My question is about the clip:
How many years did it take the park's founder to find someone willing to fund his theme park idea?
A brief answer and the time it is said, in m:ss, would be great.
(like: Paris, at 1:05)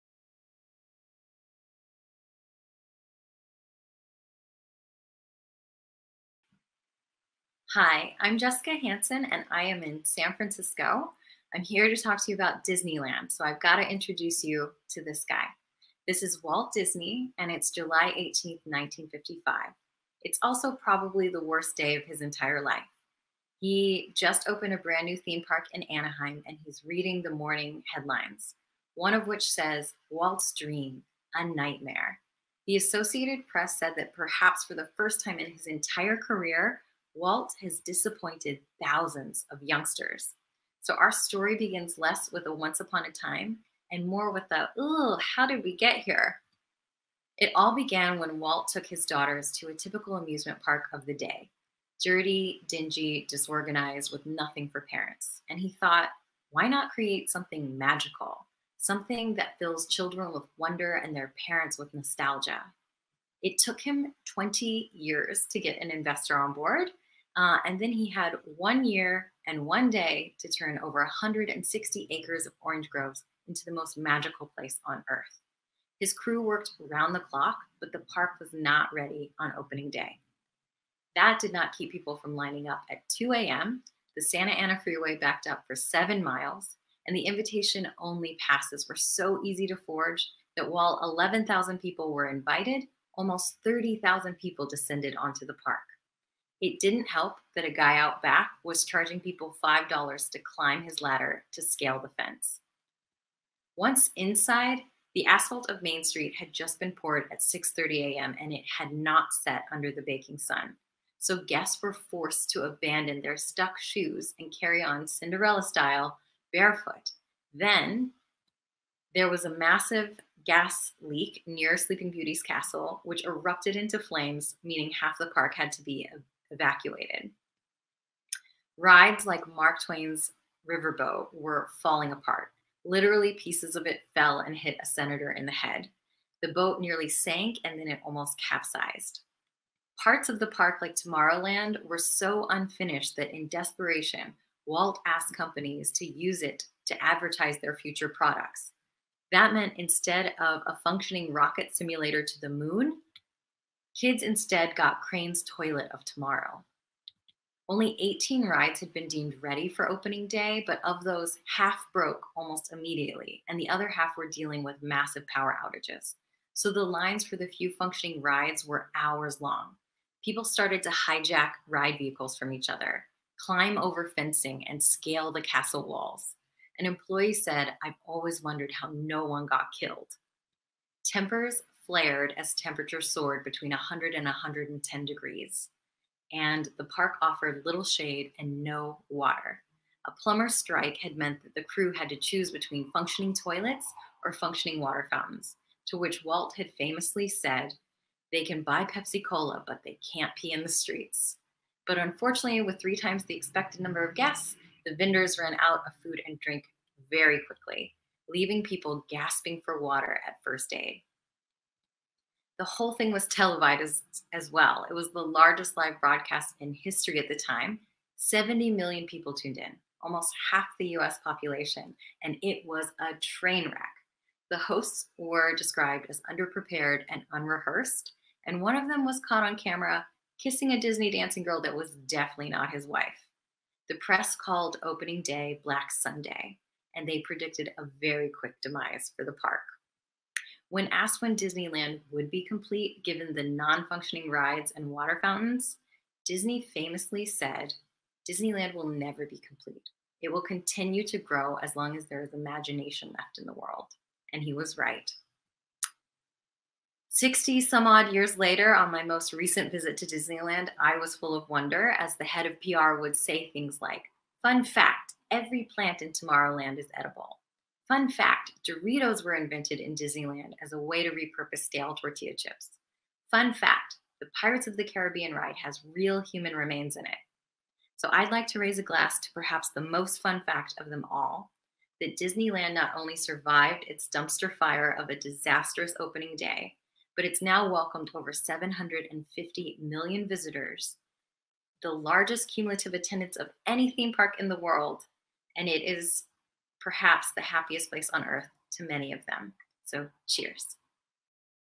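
20 years, at 1:04.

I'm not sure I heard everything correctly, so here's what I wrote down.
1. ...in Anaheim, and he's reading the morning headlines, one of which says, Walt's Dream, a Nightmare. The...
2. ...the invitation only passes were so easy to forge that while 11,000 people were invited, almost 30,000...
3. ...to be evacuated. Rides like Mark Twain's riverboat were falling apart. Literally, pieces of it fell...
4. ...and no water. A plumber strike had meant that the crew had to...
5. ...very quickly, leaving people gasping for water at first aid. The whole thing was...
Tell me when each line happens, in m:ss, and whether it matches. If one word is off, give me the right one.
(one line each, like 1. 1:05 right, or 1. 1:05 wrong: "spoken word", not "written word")
1. 0:25 right
2. 1:27 right
3. 2:05 right
4. 3:08 right
5. 3:27 right.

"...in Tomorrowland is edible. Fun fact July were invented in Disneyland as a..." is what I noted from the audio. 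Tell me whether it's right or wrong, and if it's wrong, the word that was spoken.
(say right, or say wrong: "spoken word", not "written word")
wrong: "Doritos", not "July".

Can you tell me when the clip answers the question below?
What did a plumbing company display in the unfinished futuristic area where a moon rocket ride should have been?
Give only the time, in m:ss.
2:35.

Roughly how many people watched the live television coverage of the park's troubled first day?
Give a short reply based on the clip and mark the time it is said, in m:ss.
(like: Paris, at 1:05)
70 million, at 3:38.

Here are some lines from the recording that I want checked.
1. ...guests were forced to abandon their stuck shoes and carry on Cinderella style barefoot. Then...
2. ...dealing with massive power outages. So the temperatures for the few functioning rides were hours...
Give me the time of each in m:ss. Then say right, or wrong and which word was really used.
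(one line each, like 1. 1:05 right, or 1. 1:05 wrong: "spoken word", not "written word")
1. 1:51 right
2. 2:44 wrong: "lines", not "temperatures".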